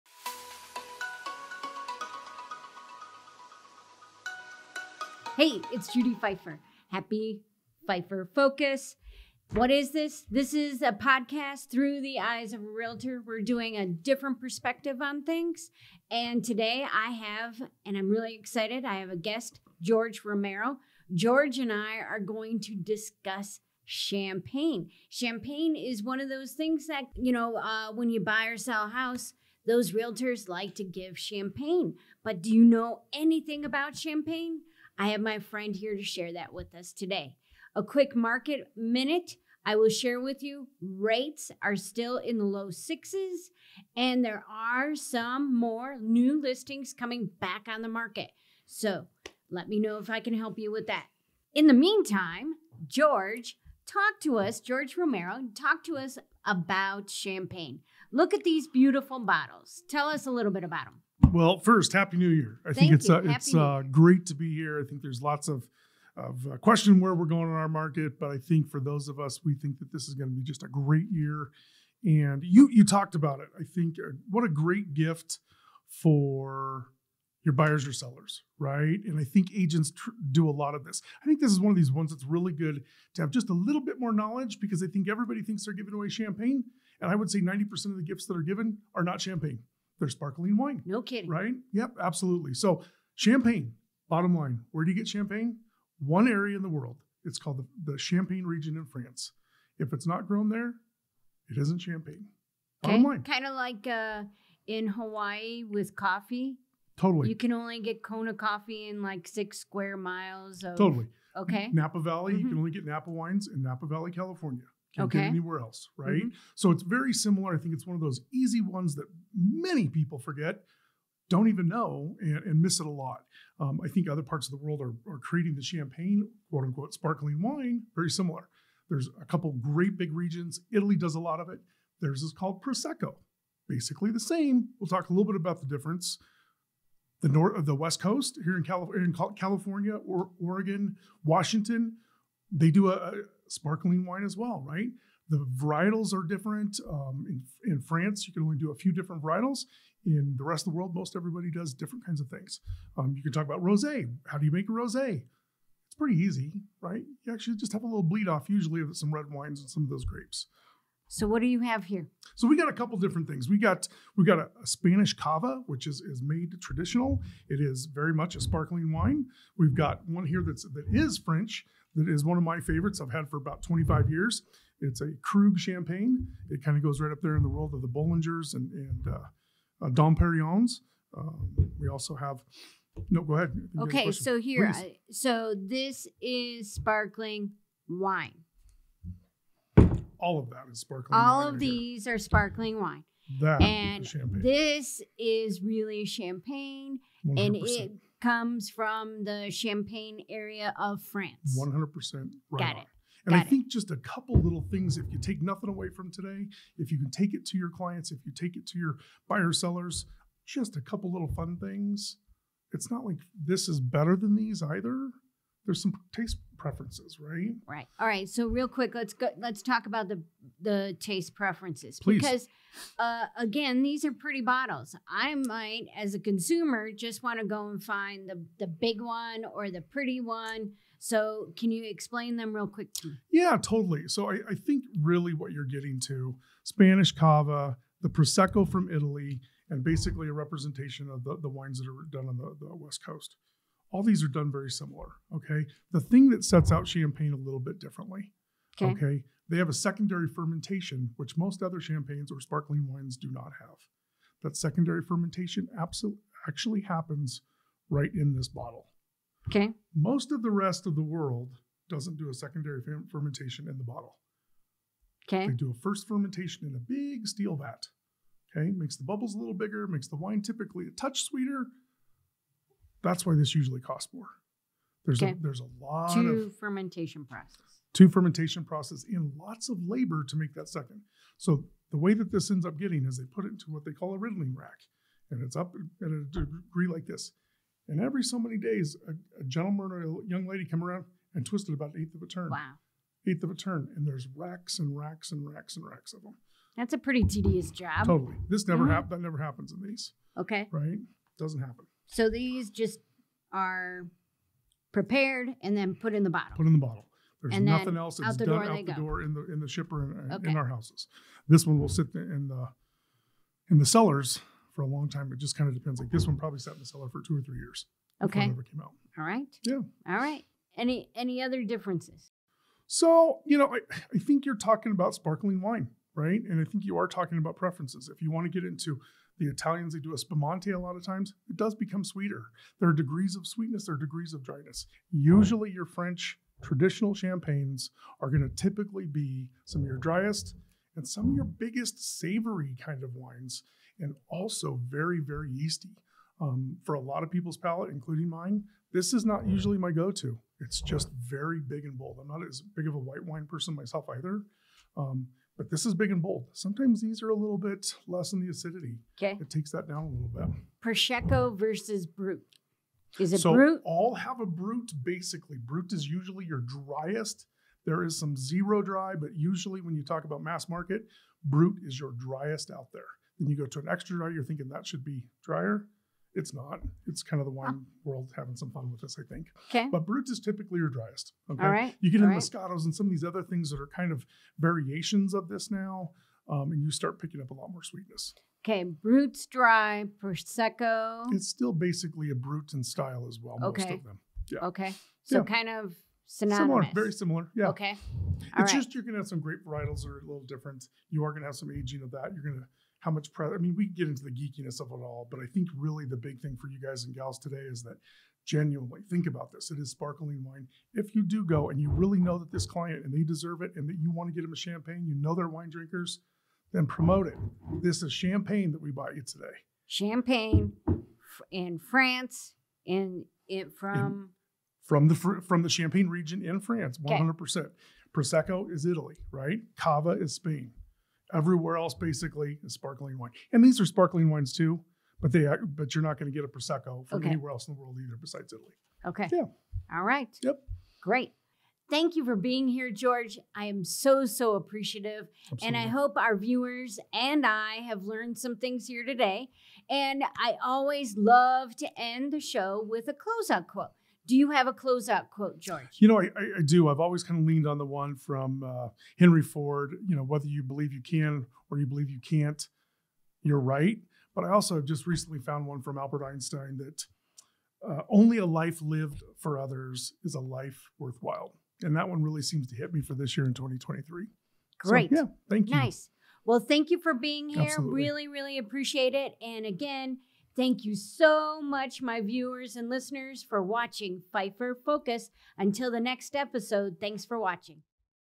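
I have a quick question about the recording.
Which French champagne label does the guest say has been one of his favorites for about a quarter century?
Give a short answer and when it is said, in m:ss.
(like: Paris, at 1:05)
Krug, at 2:55.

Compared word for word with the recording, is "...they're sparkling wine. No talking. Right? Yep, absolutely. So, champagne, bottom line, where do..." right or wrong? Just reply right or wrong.
wrong.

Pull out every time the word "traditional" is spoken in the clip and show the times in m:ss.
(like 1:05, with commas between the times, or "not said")
2:46, 5:36.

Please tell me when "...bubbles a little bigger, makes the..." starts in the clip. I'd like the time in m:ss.
4:29.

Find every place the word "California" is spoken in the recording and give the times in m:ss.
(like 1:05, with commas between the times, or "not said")
1:54, 2:19.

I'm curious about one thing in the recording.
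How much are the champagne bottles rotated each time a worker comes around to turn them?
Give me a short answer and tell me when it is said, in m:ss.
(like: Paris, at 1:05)
an eighth of a turn, at 4:51.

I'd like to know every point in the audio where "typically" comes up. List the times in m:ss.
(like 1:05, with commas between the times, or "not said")
4:30, 5:38, 6:20.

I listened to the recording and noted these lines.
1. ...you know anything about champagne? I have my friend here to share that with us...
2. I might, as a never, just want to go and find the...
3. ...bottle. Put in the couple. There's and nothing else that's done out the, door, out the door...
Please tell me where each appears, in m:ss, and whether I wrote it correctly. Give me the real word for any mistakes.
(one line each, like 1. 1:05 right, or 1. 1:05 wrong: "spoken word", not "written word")
1. 0:32 right
2. 3:45 wrong: "consumer", not "never"
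3. 5:06 wrong: "bottle", not "couple".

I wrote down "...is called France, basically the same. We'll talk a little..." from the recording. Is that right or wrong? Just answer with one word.
wrong.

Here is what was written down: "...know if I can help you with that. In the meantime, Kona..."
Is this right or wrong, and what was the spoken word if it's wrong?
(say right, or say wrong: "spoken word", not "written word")
wrong: "George", not "Kona".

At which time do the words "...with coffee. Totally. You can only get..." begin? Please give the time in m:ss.
1:45.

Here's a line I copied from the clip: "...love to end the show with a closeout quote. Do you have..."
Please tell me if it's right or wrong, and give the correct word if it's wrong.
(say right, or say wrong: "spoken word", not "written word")
right.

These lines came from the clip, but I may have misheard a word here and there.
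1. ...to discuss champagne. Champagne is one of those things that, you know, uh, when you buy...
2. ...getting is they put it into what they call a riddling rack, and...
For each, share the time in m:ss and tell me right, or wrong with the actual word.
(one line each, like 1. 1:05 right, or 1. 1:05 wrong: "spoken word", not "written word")
1. 0:22 right
2. 4:42 right.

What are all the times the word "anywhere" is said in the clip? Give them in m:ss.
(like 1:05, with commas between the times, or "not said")
1:55, 7:17.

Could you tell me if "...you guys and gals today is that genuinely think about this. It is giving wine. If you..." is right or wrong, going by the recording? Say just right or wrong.
wrong.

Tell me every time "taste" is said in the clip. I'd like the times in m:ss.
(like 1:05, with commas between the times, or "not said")
3:36, 3:40.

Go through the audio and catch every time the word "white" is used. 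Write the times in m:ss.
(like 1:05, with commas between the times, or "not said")
5:52.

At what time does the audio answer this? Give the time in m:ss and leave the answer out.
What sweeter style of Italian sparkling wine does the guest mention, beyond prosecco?
5:30.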